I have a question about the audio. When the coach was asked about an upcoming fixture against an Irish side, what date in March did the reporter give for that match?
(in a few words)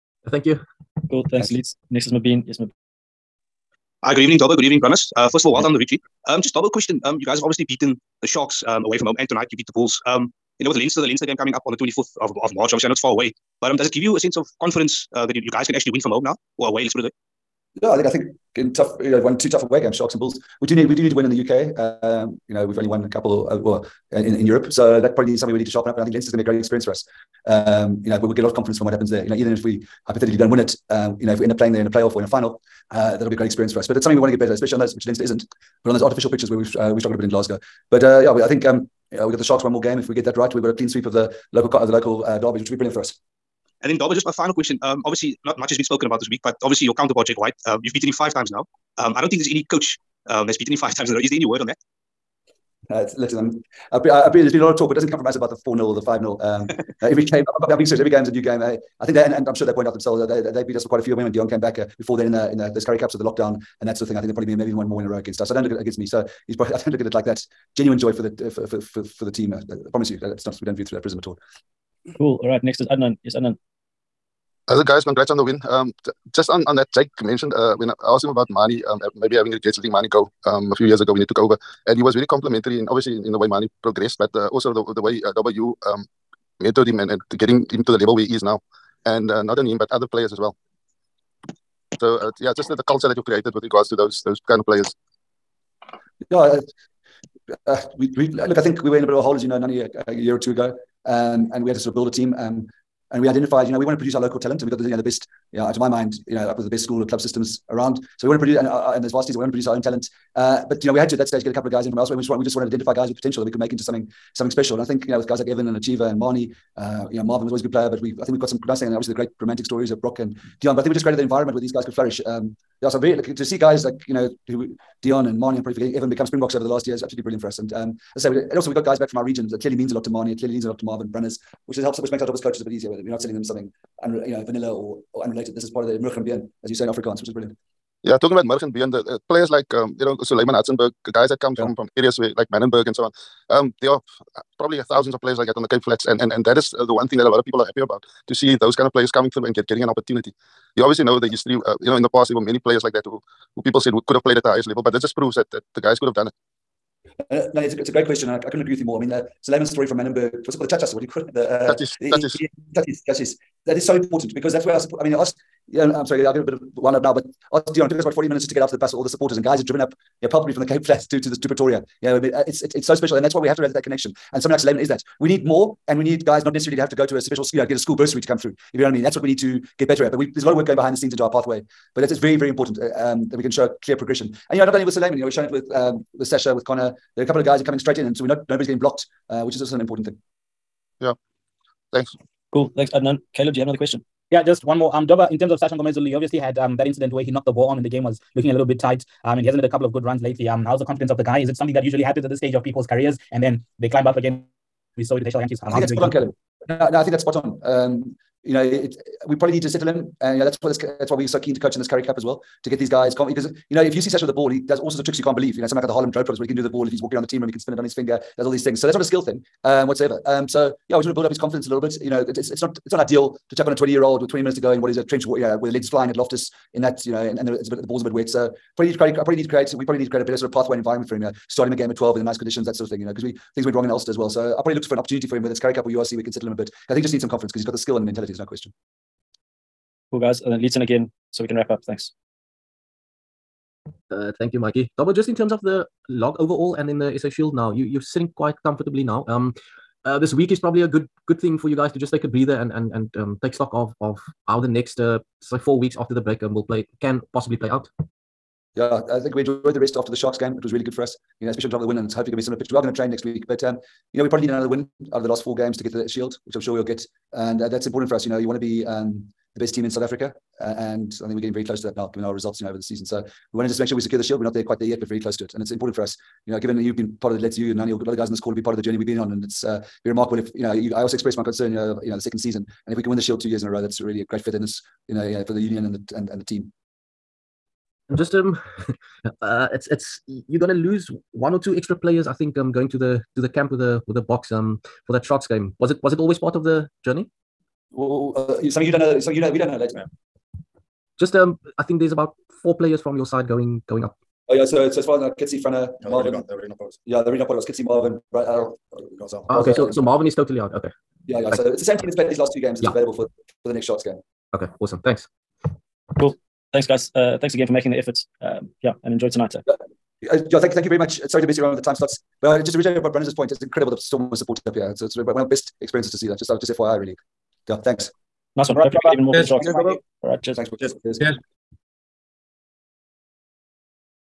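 24 March.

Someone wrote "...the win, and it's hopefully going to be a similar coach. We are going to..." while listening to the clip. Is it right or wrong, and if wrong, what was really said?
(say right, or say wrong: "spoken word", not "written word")
wrong: "pitch", not "coach".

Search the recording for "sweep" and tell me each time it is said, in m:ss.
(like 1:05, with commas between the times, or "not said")
0:40.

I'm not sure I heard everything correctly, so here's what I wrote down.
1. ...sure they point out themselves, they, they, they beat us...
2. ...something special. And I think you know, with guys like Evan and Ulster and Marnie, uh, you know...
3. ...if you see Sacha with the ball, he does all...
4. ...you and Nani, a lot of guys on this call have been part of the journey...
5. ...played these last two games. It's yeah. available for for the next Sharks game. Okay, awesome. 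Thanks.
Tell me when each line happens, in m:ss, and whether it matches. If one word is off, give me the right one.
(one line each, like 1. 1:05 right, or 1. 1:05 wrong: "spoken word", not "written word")
1. 0:59 right
2. 1:54 wrong: "Hacjivah", not "Ulster"
3. 3:33 right
4. 4:37 right
5. 5:12 right.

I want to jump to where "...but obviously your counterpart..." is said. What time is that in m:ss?
0:46.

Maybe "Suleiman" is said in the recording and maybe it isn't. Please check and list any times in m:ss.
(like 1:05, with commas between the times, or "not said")
2:20, 2:39, 2:54, 3:04.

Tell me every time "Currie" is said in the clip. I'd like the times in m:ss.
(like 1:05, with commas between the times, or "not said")
1:02, 3:31, 3:55.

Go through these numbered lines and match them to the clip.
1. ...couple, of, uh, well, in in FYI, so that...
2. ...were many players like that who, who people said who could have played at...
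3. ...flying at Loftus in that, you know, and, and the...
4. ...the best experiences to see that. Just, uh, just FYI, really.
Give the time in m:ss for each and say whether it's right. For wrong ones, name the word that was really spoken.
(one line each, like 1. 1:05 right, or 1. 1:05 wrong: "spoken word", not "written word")
1. 0:23 wrong: "Europe", not "FYI"
2. 2:32 right
3. 3:45 right
4. 5:25 right.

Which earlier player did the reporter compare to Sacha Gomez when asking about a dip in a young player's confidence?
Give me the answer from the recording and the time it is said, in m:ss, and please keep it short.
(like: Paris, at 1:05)
HL Jantjies, at 3:25.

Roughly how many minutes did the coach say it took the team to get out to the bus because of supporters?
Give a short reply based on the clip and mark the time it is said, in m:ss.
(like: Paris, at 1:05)
40 minutes, at 2:48.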